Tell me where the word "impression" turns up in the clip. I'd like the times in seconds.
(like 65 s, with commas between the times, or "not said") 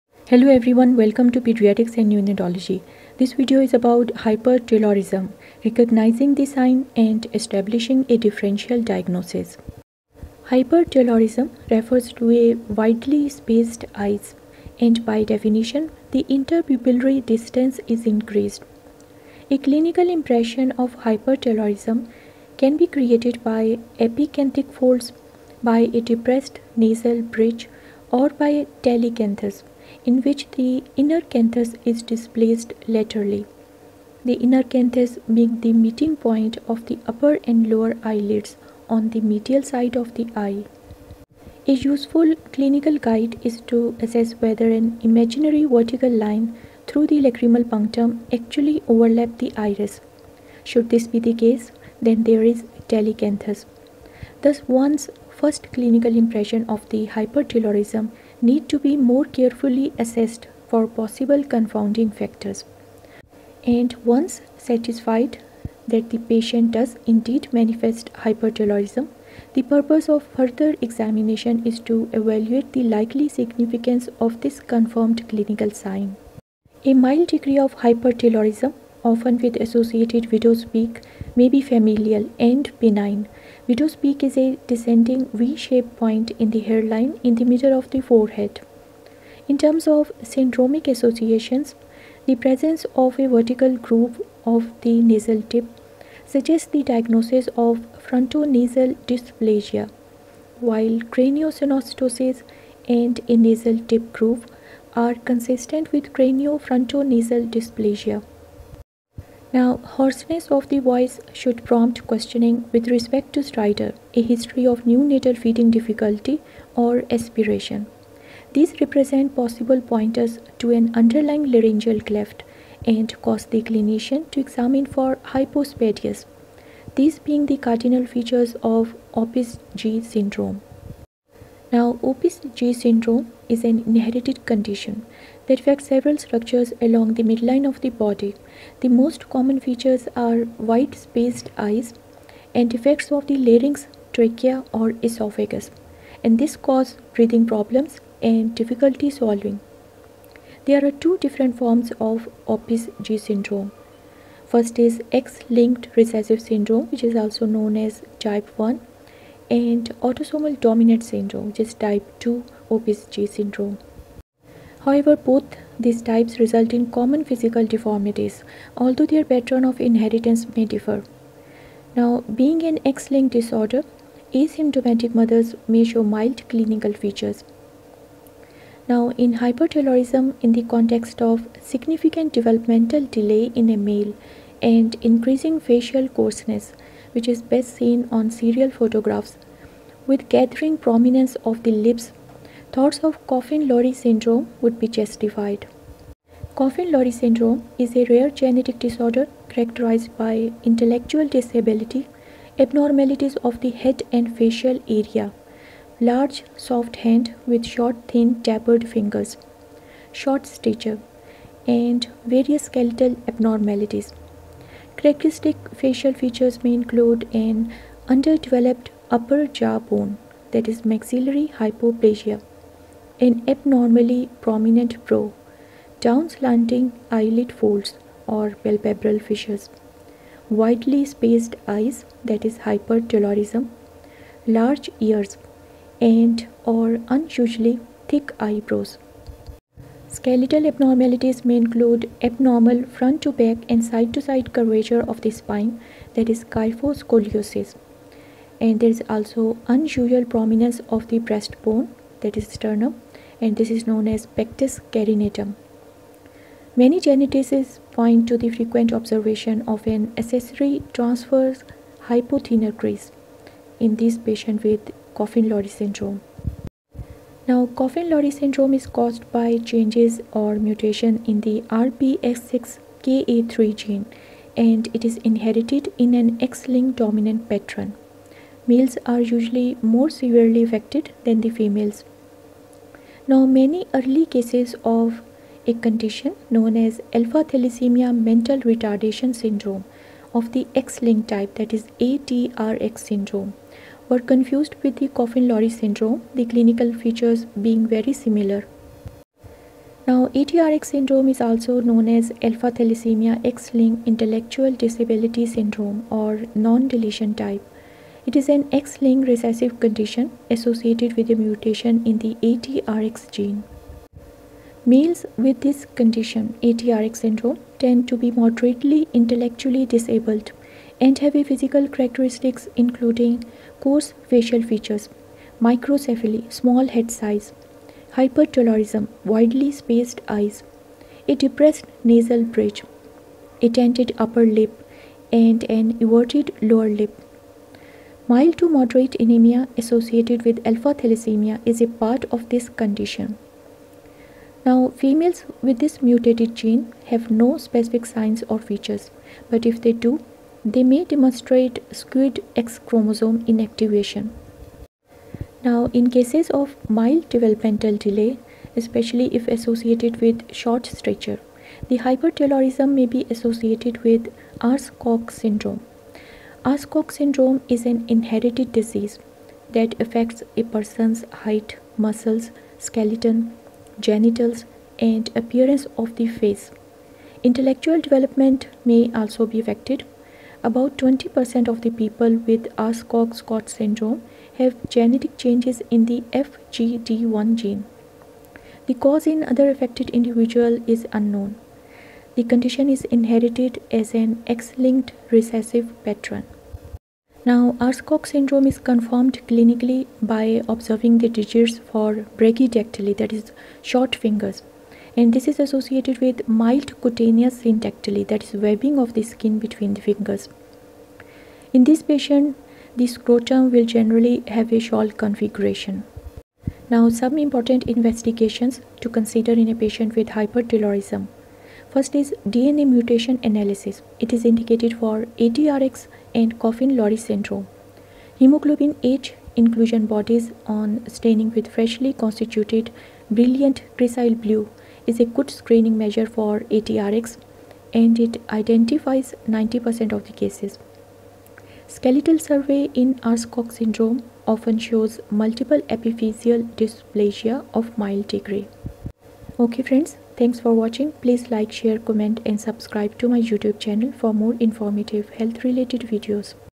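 20 s, 56 s.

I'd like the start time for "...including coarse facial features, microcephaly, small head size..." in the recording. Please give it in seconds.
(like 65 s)
322 s.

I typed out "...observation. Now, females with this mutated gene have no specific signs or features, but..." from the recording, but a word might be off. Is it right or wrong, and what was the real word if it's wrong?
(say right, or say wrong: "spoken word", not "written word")
wrong: "condition", not "observation".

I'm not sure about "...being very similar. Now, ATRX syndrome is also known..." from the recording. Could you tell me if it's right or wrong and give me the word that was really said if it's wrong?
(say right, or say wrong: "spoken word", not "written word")
right.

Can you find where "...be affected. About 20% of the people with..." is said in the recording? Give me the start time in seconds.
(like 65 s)
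379 s.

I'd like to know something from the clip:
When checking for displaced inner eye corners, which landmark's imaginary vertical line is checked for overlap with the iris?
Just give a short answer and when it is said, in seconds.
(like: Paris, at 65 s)
Lacrimal punctum, at 47 s.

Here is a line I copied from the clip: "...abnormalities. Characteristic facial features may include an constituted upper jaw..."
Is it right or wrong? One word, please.
wrong.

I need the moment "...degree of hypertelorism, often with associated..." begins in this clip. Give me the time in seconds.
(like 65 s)
77 s.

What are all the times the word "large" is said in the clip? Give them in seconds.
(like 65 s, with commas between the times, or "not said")
205 s, 234 s.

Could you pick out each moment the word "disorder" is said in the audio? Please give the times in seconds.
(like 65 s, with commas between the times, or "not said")
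173 s, 198 s.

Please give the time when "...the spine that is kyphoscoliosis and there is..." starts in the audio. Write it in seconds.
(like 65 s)
245 s.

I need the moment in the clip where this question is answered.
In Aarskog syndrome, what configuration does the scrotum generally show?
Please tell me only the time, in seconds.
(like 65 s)
414 s.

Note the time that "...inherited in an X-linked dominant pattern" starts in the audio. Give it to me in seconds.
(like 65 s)
275 s.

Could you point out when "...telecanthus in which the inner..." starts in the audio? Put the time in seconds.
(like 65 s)
28 s.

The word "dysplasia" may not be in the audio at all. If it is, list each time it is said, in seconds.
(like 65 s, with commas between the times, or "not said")
99 s, 107 s, 446 s.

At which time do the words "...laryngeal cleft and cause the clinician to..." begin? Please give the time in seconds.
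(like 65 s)
121 s.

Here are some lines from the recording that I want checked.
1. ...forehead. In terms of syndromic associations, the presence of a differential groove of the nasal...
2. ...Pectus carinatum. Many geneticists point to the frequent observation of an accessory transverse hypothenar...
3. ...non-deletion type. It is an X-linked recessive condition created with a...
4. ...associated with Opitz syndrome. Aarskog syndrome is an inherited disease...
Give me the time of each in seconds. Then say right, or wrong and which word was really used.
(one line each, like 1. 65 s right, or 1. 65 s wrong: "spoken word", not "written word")
1. 88 s wrong: "vertical", not "differential"
2. 254 s right
3. 306 s wrong: "associated", not "created"
4. 363 s wrong: "Aarskog", not "Opitz".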